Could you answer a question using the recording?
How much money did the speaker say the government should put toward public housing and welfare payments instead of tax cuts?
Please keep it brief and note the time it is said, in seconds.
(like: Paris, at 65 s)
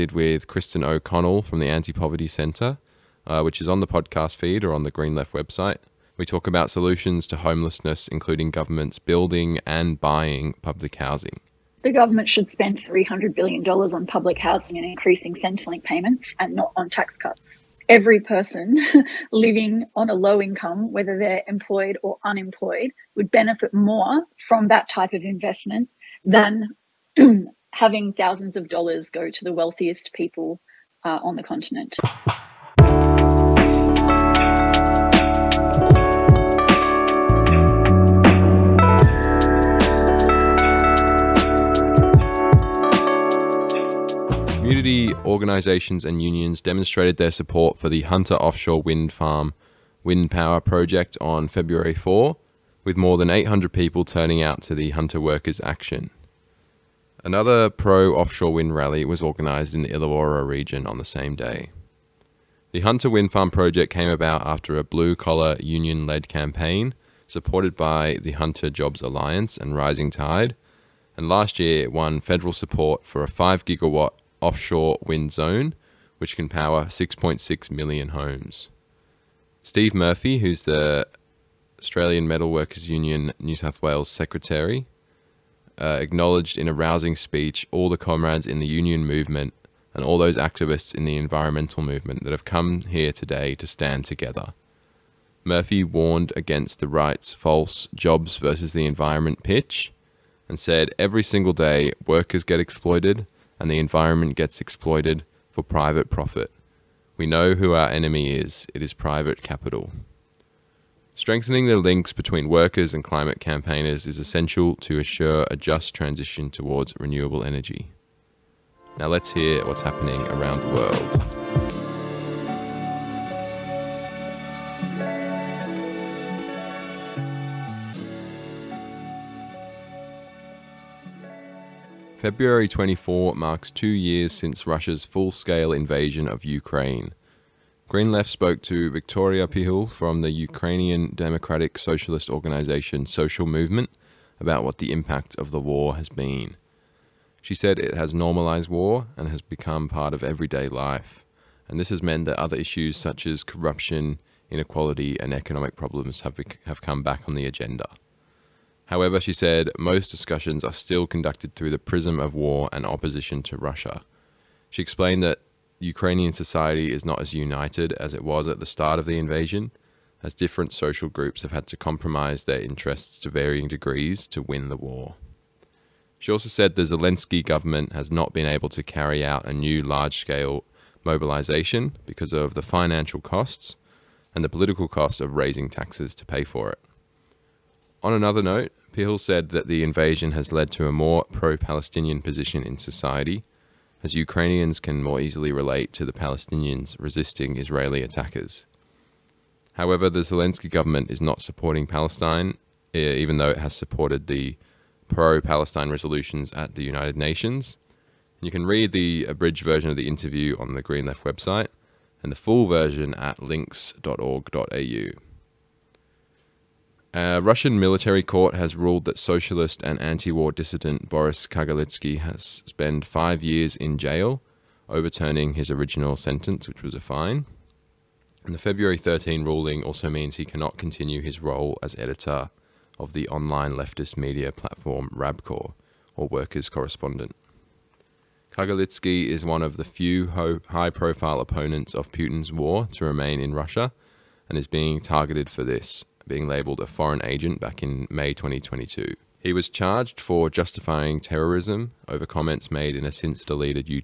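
$300 billion, at 12 s.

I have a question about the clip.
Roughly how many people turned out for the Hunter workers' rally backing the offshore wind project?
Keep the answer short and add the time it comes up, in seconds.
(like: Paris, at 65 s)
800, at 53 s.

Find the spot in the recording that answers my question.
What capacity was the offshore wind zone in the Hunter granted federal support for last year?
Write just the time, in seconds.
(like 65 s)
73 s.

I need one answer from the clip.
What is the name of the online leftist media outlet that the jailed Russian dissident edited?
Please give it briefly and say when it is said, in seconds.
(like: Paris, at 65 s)
Rabkor, at 235 s.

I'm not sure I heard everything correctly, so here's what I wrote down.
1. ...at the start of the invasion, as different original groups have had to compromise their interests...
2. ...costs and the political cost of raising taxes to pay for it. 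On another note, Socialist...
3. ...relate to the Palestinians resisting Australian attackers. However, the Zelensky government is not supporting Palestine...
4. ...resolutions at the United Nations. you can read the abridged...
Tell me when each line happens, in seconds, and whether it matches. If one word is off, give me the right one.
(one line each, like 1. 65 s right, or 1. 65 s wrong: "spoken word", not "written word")
1. 168 s wrong: "social", not "original"
2. 183 s wrong: "Pihul", not "Socialist"
3. 195 s wrong: "Israeli", not "Australian"
4. 205 s right.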